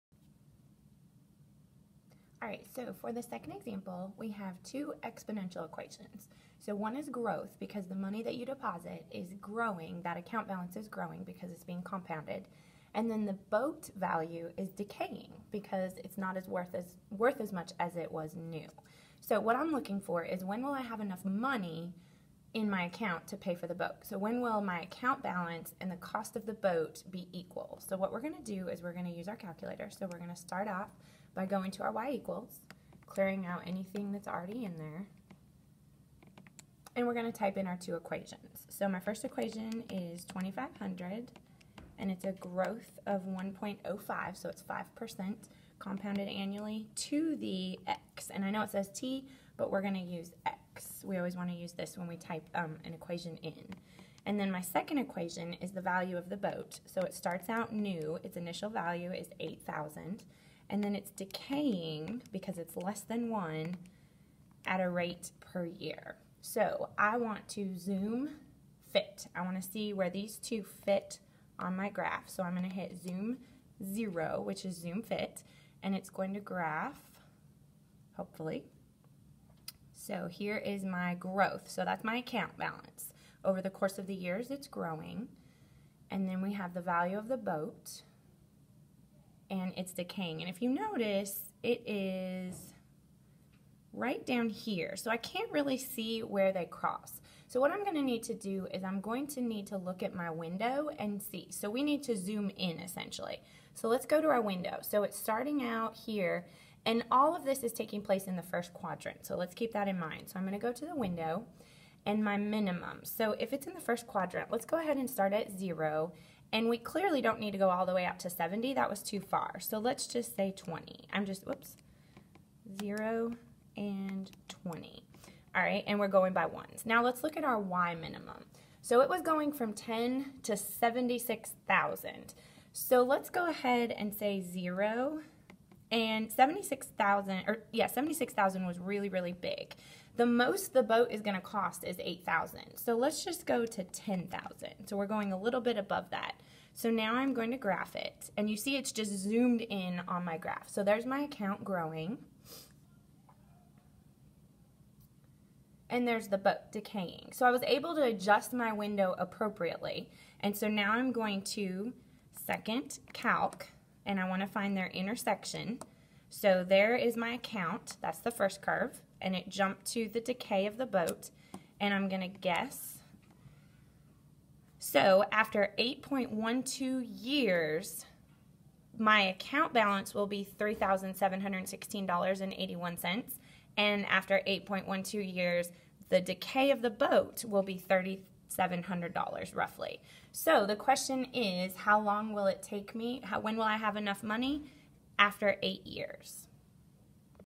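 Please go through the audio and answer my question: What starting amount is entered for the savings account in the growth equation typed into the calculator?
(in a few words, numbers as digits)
2,500.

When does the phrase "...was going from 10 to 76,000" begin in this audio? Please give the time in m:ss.
2:09.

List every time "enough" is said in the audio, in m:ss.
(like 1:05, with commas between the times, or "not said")
0:20, 3:13.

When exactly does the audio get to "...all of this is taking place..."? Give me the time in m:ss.
1:47.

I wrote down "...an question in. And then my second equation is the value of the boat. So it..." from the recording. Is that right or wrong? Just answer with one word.
wrong.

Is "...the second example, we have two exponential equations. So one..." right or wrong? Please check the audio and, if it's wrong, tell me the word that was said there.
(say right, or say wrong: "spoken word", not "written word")
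right.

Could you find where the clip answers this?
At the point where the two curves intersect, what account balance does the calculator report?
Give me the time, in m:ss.
3:00.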